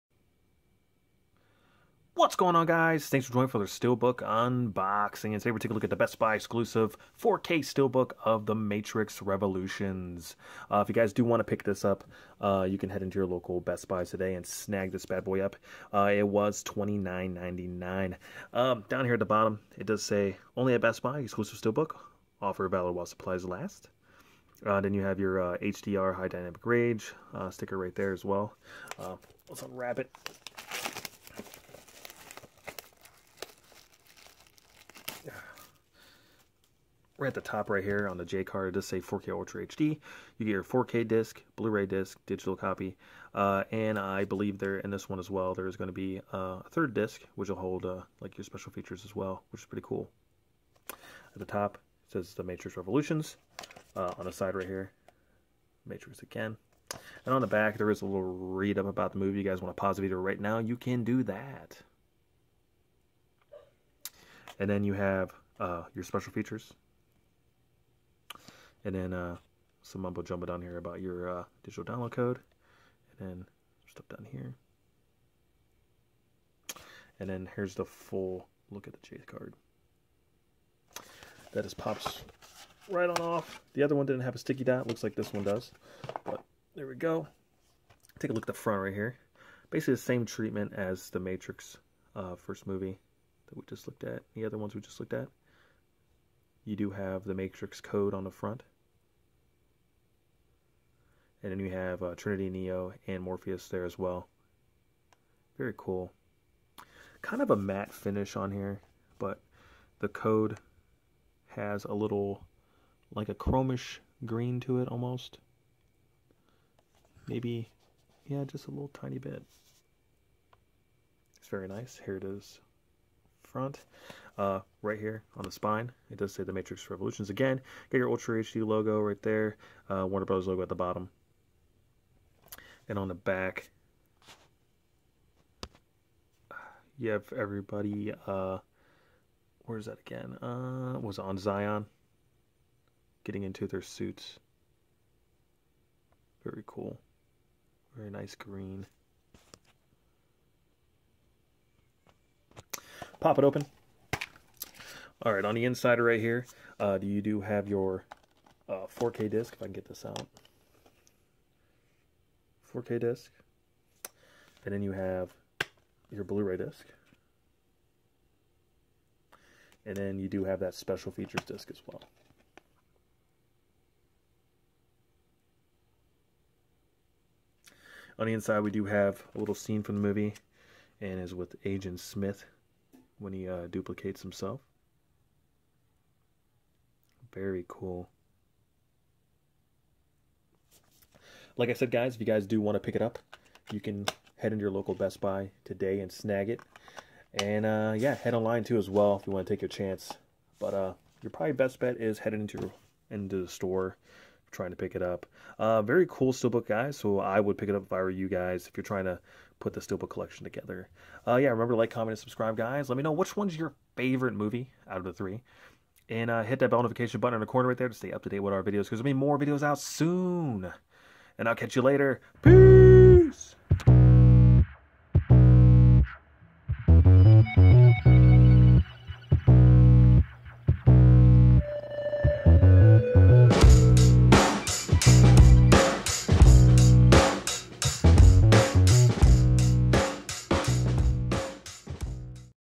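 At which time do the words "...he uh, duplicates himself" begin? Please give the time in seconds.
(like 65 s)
183 s.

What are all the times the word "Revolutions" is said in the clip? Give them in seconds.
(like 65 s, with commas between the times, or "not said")
9 s, 52 s, 126 s.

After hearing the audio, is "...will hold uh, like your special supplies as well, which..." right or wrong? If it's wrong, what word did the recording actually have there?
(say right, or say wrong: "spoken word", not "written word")
wrong: "features", not "supplies".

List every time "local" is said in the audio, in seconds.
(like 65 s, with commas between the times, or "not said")
13 s, 194 s.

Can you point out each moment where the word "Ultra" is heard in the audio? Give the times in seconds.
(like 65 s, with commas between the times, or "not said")
39 s, 128 s.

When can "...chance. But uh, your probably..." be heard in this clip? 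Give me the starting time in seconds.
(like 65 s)
199 s.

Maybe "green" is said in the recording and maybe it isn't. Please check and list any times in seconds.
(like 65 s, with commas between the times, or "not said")
114 s, 148 s.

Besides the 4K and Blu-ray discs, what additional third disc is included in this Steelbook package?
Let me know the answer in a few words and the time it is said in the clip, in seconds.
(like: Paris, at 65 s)
special features disc, at 170 s.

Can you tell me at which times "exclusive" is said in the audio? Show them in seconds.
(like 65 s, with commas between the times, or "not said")
6 s, 21 s.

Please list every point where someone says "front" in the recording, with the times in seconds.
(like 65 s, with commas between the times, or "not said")
88 s, 98 s, 123 s.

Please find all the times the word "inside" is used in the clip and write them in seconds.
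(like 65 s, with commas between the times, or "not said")
155 s, 178 s.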